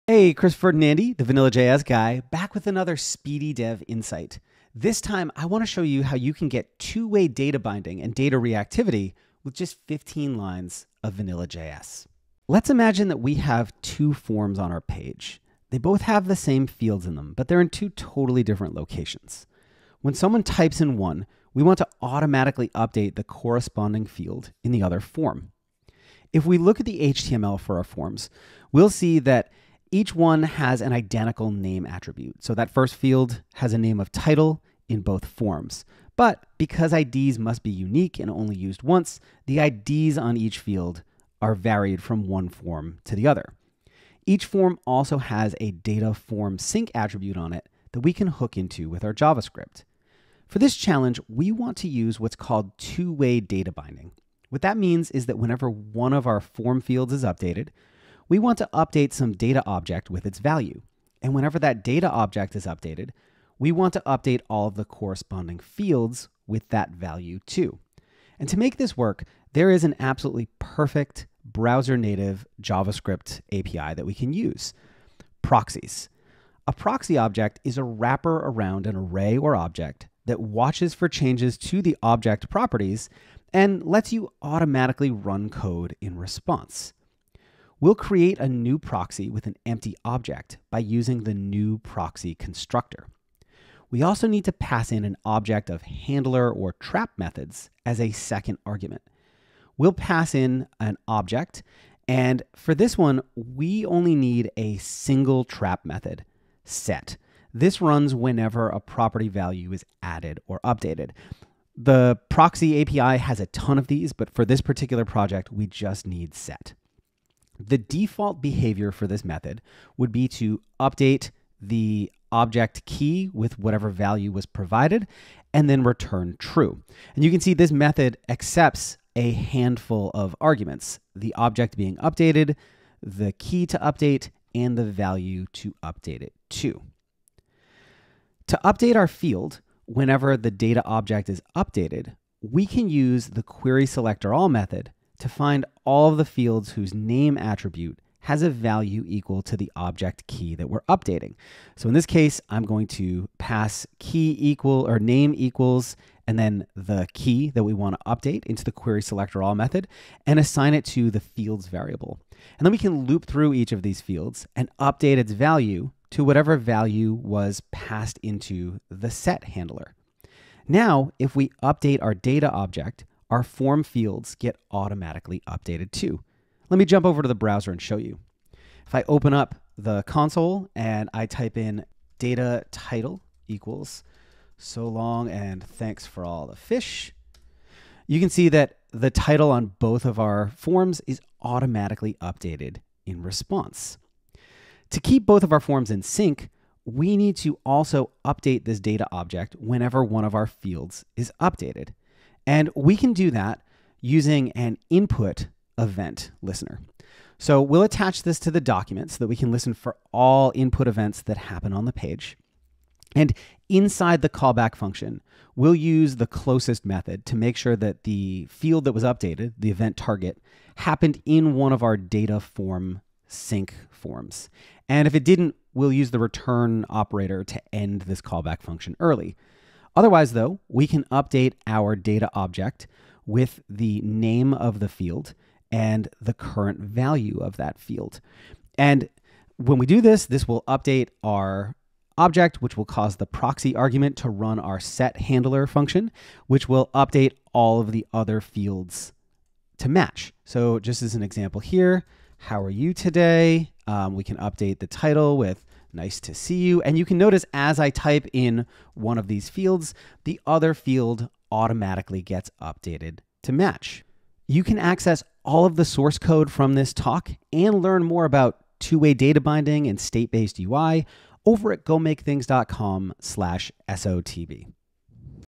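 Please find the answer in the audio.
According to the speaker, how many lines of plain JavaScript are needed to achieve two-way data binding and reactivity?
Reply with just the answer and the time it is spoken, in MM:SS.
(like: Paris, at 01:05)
15, at 00:09.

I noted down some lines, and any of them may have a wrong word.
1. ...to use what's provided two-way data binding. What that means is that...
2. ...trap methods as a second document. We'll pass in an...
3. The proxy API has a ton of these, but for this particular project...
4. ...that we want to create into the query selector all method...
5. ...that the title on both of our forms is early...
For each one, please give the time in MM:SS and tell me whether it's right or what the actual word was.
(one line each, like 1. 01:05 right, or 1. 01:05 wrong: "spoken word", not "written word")
1. 00:51 wrong: "called", not "provided"
2. 01:36 wrong: "argument", not "document"
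3. 01:51 right
4. 02:37 wrong: "update", not "create"
5. 03:08 wrong: "automatically", not "early".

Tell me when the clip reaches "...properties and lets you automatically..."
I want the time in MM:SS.
01:22.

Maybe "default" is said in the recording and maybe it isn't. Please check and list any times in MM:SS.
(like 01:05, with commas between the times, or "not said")
01:57.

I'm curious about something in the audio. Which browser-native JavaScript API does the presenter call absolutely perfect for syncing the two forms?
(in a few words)
Proxies.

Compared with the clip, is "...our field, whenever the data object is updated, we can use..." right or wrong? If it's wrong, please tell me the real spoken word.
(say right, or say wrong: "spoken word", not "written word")
right.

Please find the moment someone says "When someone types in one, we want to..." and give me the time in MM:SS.
00:20.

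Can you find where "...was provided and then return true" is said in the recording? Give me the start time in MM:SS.
02:04.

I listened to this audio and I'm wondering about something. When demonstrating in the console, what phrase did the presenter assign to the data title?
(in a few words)
So long and thanks for all the fish.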